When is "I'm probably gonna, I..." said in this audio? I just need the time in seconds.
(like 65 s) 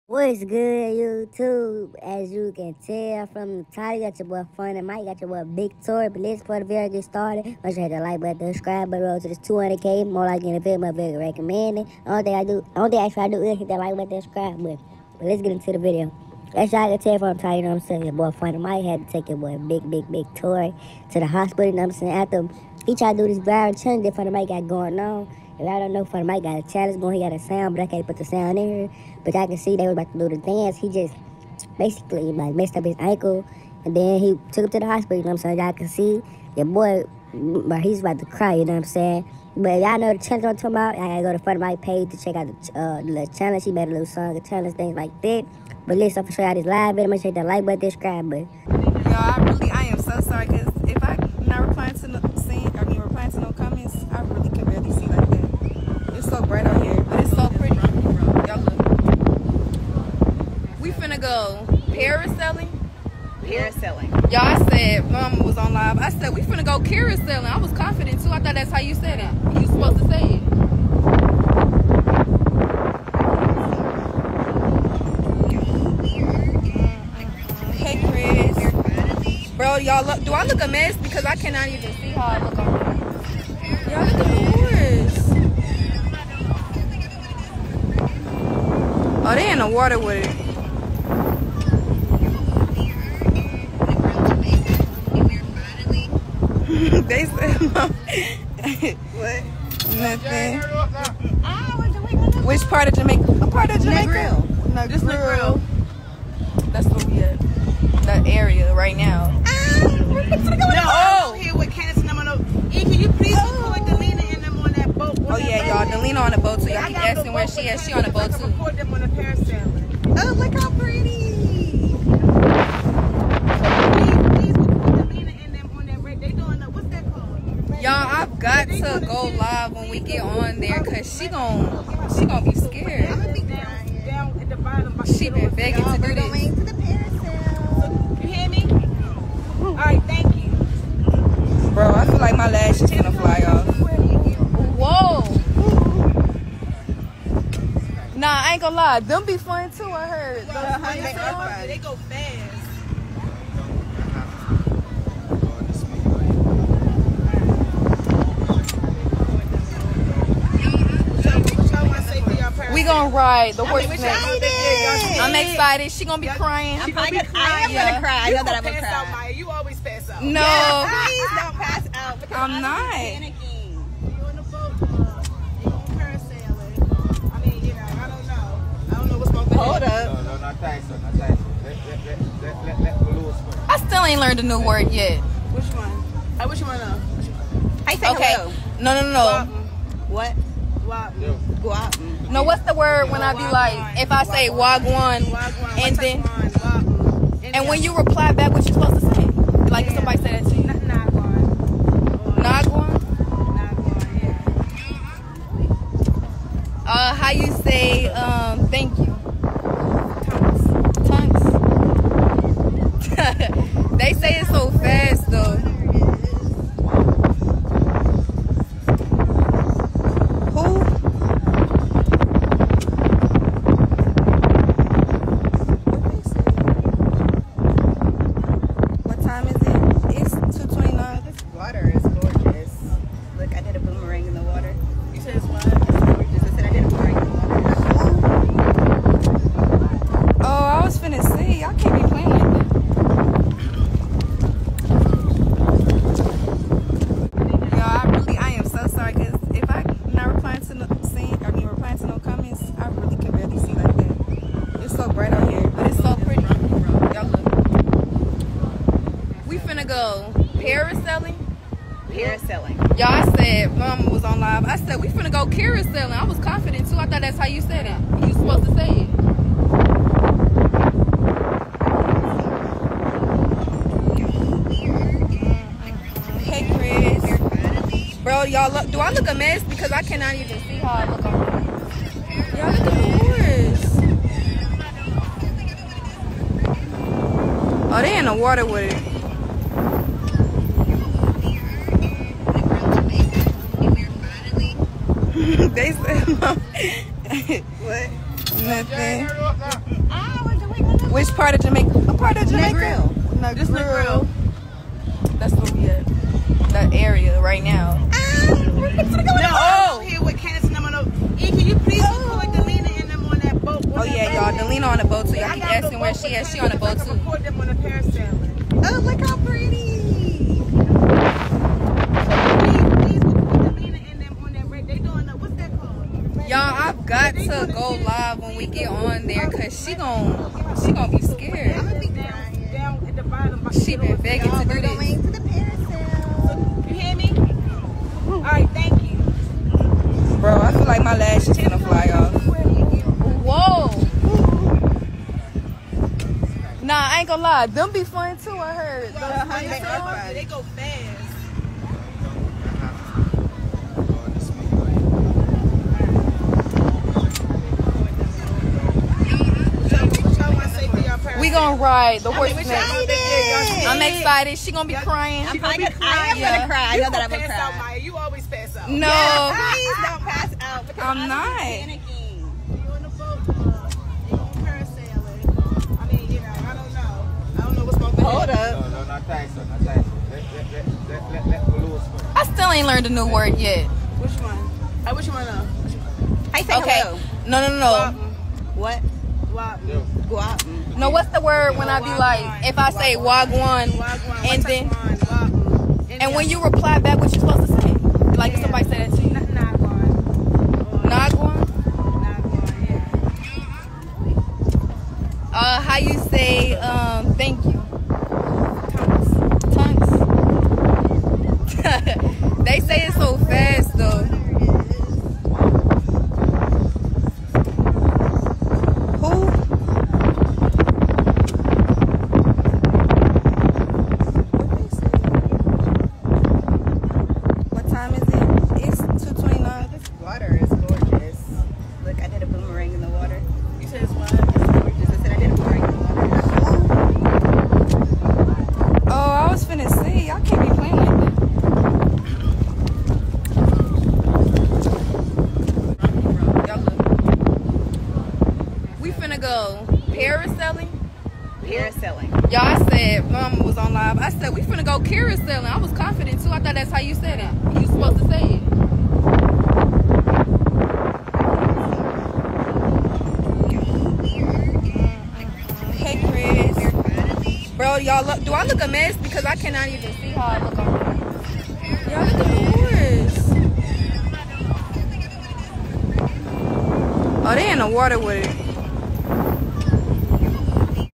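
365 s.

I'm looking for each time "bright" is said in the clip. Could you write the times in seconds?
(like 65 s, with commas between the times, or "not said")
56 s.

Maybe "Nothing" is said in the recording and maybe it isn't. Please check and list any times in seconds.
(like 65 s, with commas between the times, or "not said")
99 s, 298 s.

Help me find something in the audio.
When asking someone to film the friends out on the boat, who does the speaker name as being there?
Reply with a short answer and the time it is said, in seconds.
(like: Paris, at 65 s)
Candace, at 310 s.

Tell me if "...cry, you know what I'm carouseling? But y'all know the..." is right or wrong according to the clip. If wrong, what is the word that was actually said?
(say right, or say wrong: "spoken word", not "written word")
wrong: "saying", not "carouseling".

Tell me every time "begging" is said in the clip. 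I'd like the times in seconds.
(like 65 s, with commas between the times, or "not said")
135 s, 334 s.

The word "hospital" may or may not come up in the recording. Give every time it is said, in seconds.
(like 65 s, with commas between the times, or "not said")
21 s, 34 s.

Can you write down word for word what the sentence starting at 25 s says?
If I don't know, FunnyMike got a challenge going, he got a sound, but I can't put the sound in here.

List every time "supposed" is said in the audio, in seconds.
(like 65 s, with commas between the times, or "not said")
69 s, 198 s, 268 s, 397 s, 457 s.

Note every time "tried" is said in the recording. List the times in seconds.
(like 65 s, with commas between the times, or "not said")
22 s.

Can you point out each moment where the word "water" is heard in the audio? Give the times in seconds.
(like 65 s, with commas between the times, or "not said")
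89 s, 288 s, 477 s.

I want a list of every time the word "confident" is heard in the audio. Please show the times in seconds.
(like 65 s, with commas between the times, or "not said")
67 s, 266 s, 455 s.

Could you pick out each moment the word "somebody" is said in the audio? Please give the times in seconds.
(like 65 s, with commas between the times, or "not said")
199 s, 398 s.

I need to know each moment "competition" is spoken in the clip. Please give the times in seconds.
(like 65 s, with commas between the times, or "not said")
not said.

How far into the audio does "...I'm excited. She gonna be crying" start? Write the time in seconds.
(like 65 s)
163 s.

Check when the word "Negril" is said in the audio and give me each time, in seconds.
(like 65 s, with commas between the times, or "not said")
105 s, 303 s.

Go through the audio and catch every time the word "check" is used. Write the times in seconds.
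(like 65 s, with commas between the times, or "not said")
42 s, 47 s.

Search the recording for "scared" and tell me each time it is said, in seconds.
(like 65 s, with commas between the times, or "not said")
132 s, 331 s.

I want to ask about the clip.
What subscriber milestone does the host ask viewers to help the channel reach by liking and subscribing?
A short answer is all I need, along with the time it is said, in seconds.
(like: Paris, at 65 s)
200k, at 9 s.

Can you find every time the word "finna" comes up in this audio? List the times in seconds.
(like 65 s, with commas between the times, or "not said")
60 s, 66 s, 265 s, 454 s.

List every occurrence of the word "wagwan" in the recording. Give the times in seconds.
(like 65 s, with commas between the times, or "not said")
194 s, 393 s.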